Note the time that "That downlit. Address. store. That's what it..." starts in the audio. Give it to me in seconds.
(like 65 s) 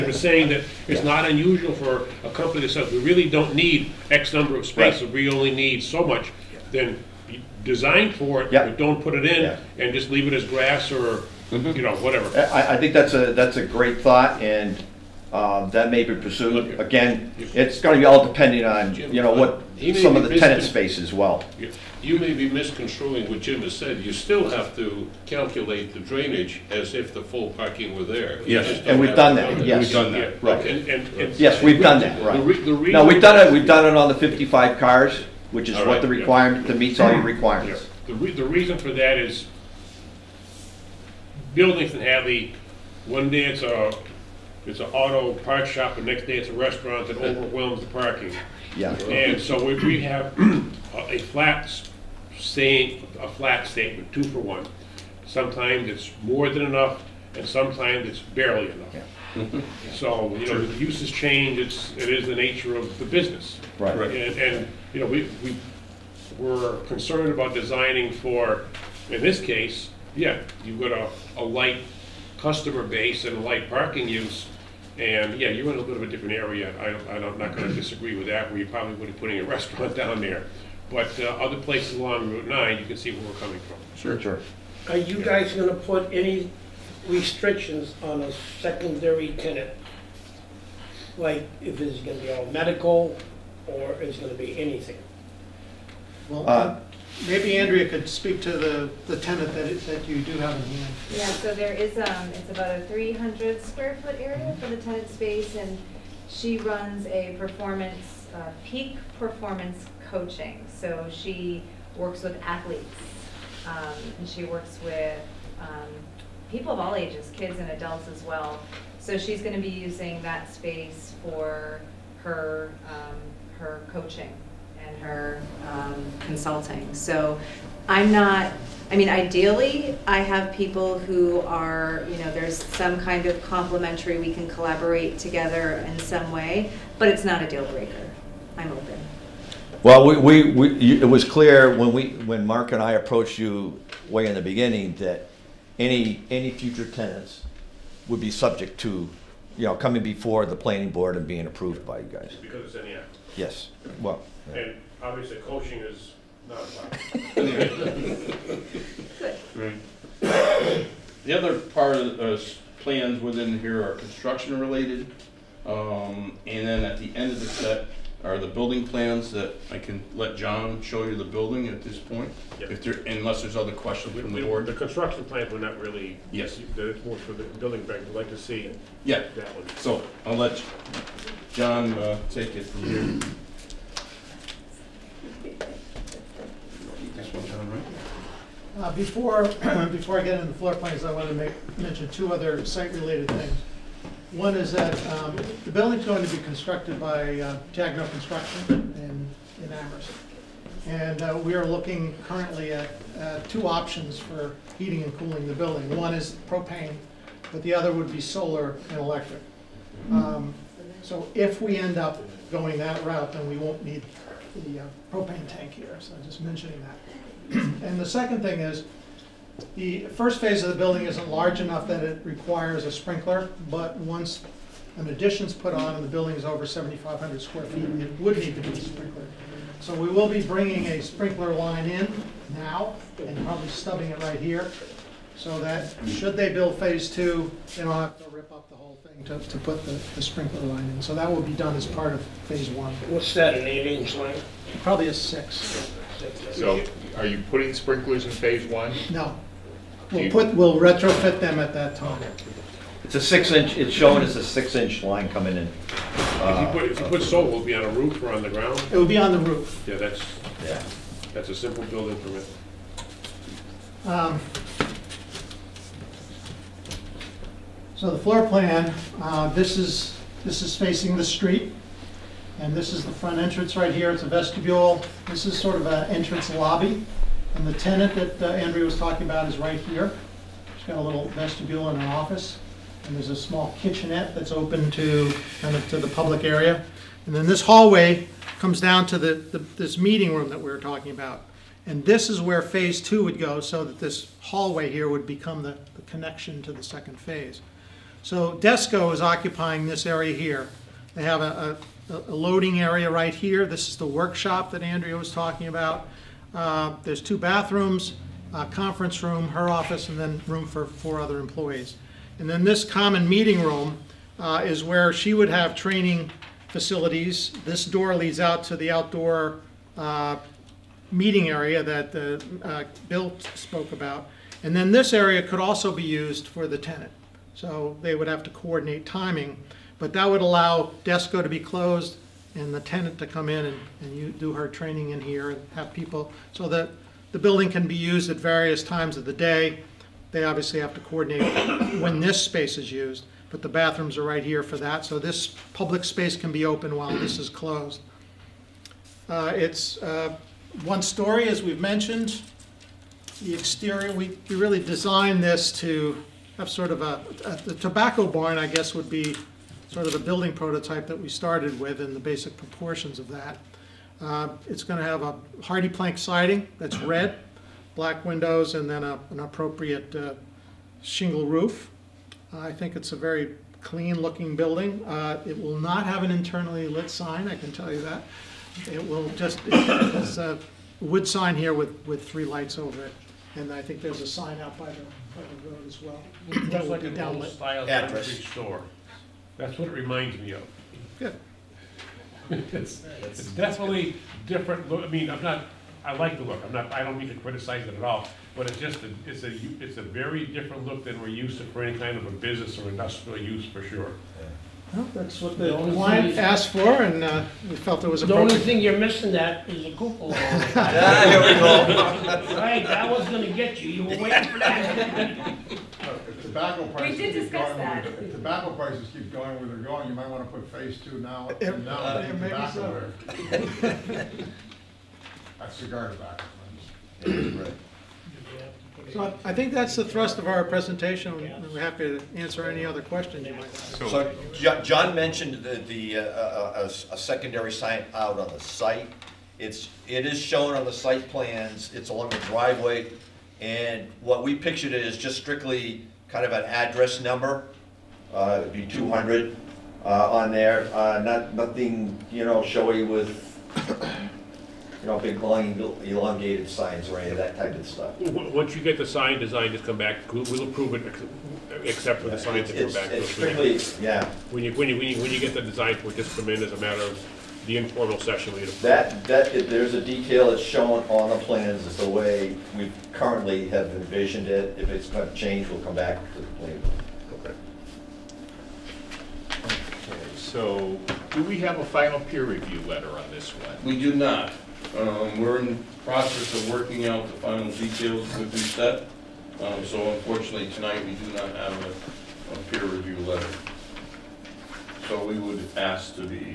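386 s.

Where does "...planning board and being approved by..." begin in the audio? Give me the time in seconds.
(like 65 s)
150 s.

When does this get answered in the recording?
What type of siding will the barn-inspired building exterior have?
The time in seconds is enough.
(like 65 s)
365 s.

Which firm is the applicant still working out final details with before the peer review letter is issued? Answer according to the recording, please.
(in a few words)
Doucette.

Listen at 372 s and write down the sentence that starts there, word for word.
Uh, I think it's a very clean looking building.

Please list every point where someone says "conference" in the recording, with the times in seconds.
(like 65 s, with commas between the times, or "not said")
308 s.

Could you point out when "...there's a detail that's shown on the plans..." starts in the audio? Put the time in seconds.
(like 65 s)
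469 s.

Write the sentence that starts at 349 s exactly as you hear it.
Uh, it's uh, one story, as we've mentioned.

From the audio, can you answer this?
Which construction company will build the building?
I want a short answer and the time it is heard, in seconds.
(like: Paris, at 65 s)
Tagno Construction, at 197 s.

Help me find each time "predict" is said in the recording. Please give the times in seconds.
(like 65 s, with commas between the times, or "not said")
not said.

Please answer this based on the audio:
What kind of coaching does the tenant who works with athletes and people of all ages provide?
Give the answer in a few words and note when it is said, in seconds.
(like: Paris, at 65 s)
Peak performance coaching, at 108 s.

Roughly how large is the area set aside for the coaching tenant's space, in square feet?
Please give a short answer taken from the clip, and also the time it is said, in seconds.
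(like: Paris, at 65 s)
300 square feet, at 102 s.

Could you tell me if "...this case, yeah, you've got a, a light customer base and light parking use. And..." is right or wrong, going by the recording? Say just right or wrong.
right.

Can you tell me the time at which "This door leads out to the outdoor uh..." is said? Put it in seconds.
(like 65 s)
317 s.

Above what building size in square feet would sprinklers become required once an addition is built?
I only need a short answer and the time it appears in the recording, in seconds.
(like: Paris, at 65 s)
7,500, at 226 s.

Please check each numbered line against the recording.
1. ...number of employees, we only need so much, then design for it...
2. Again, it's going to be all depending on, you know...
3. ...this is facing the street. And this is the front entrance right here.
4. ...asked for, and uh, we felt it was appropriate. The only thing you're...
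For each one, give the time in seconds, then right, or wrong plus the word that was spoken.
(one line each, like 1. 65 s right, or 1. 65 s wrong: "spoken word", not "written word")
1. 4 s wrong: "spaces", not "employees"
2. 16 s right
3. 270 s right
4. 406 s right.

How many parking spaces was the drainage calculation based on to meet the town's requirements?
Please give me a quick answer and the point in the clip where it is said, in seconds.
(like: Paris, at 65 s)
55, at 34 s.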